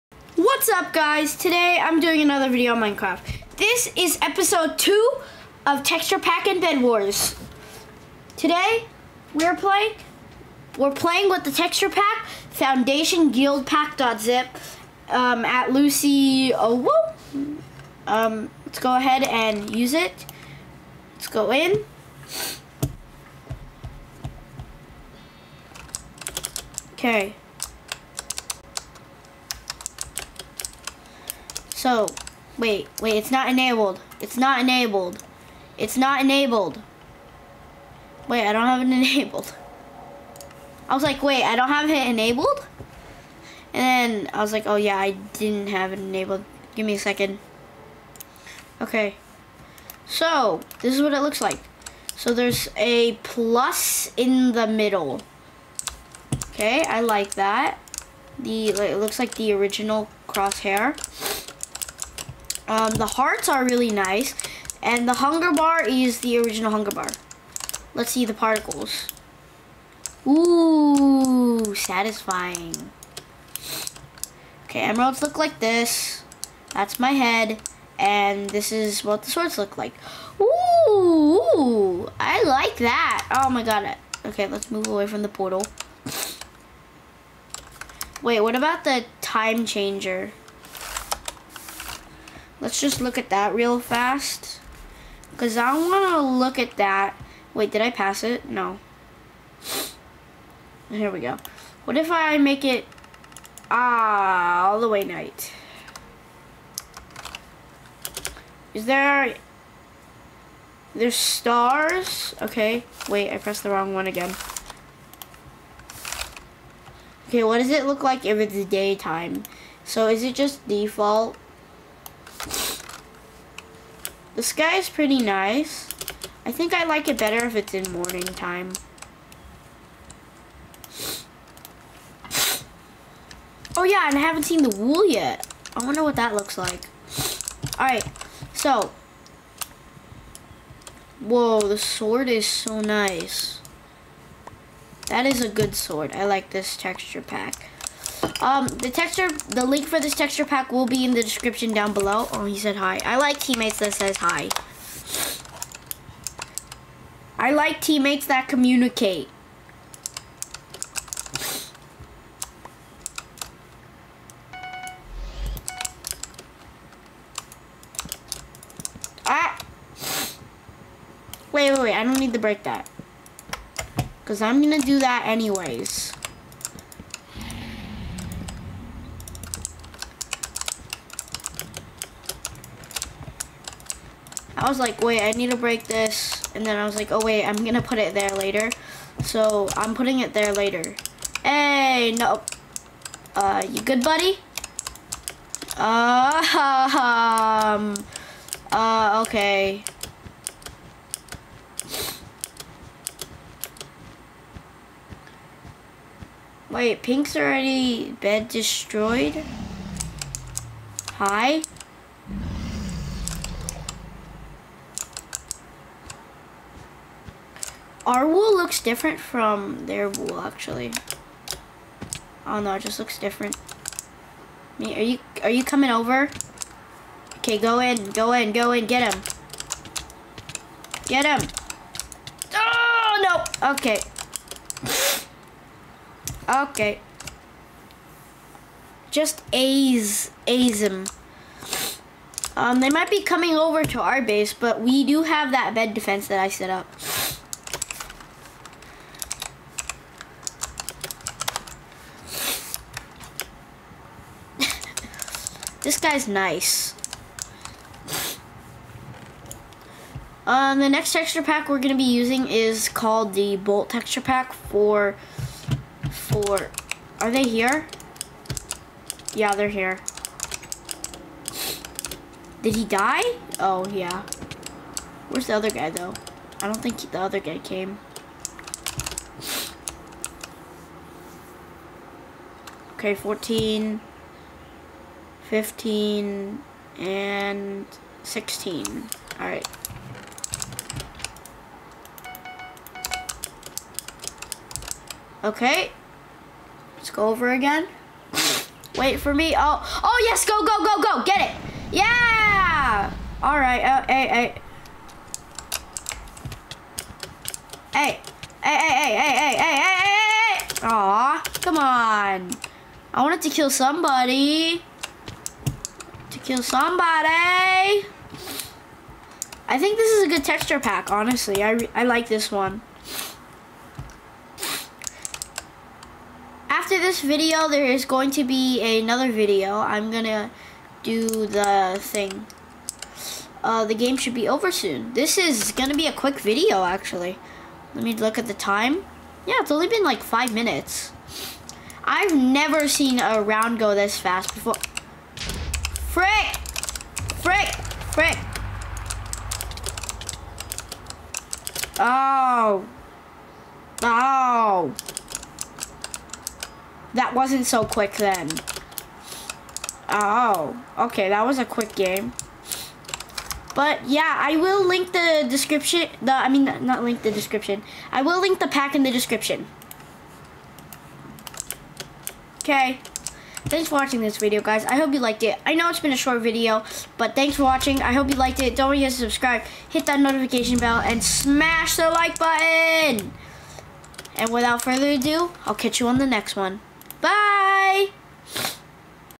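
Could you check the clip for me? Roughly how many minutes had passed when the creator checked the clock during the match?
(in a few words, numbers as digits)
5.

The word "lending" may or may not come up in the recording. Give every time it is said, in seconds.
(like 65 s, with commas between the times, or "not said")
not said.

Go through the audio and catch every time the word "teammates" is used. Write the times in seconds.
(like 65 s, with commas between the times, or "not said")
153 s, 157 s.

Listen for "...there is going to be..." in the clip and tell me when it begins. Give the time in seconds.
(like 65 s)
327 s.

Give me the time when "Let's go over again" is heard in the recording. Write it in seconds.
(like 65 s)
296 s.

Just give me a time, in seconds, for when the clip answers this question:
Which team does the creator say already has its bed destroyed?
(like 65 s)
207 s.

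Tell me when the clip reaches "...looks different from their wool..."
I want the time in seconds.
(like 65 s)
218 s.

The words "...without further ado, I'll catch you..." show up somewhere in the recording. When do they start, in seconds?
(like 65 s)
384 s.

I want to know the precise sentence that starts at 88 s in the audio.
Wait, what about the time changer?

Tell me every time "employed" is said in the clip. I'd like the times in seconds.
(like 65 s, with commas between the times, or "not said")
not said.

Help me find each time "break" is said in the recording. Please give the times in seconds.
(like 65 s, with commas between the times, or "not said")
172 s, 185 s.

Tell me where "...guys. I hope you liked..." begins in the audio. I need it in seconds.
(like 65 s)
374 s.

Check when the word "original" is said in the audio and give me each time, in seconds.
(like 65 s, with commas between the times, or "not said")
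59 s, 66 s.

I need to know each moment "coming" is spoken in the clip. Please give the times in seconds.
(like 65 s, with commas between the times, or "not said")
225 s, 243 s.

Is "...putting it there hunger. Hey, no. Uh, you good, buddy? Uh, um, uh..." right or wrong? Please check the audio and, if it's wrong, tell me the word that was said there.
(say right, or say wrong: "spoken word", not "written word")
wrong: "later", not "hunger".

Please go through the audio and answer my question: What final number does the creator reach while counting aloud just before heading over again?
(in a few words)
16.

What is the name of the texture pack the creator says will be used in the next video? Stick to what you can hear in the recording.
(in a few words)
Bolt.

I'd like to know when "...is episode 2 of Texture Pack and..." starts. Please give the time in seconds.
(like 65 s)
3 s.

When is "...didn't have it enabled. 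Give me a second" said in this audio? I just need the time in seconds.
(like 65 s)
45 s.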